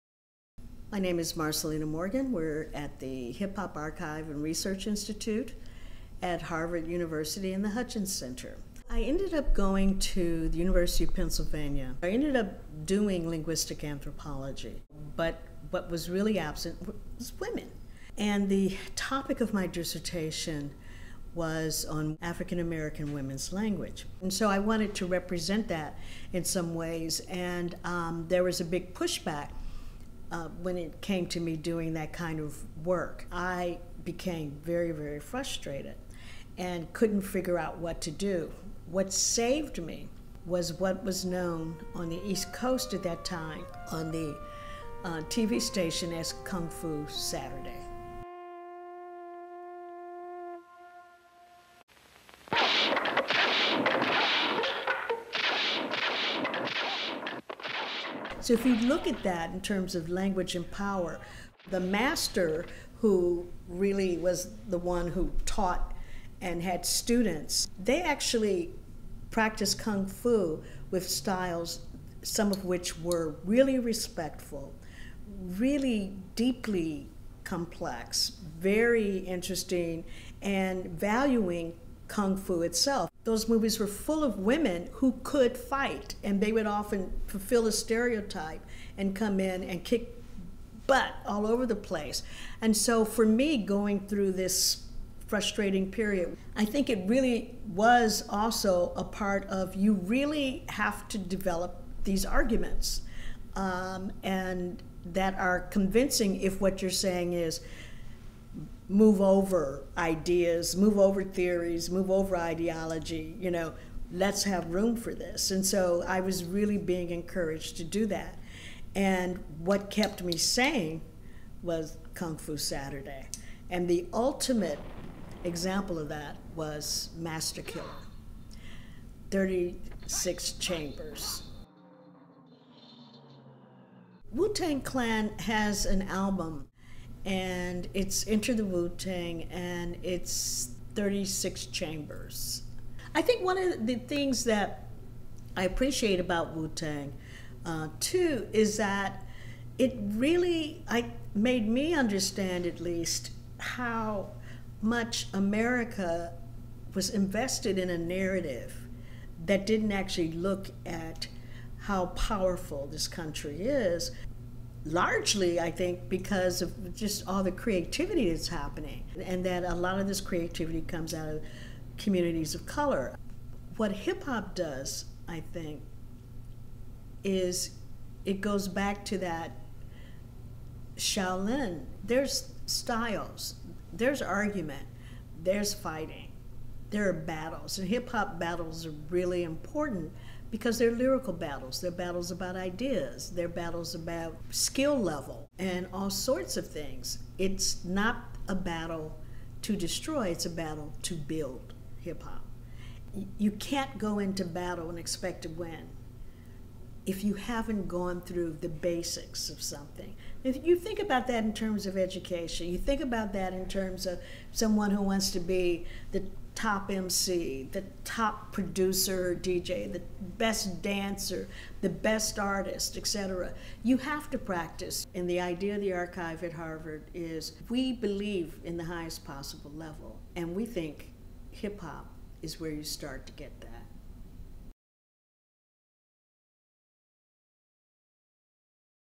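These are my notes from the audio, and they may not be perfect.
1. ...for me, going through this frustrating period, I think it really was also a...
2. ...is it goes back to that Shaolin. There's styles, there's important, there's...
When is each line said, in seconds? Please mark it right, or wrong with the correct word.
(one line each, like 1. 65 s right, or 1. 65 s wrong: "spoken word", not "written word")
1. 93 s right
2. 177 s wrong: "argument", not "important".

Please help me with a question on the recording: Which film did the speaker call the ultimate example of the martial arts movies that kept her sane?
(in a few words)
Master Killer 36 Chambers.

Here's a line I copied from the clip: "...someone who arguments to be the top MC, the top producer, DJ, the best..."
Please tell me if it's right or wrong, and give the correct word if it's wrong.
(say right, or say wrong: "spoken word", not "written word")
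wrong: "wants", not "arguments".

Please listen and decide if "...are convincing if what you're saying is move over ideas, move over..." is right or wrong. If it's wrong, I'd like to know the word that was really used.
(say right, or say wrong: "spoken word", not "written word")
right.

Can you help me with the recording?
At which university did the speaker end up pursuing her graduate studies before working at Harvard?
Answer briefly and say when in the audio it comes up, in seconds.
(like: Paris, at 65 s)
University of Pennsylvania, at 10 s.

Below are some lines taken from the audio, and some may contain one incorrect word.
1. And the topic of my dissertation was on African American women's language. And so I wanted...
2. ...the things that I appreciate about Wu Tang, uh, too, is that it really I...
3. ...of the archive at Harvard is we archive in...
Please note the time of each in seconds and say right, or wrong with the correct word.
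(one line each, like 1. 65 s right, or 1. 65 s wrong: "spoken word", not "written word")
1. 18 s right
2. 143 s right
3. 225 s wrong: "believe", not "archive".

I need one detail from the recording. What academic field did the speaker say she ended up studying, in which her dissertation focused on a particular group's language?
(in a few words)
Linguistic anthropology.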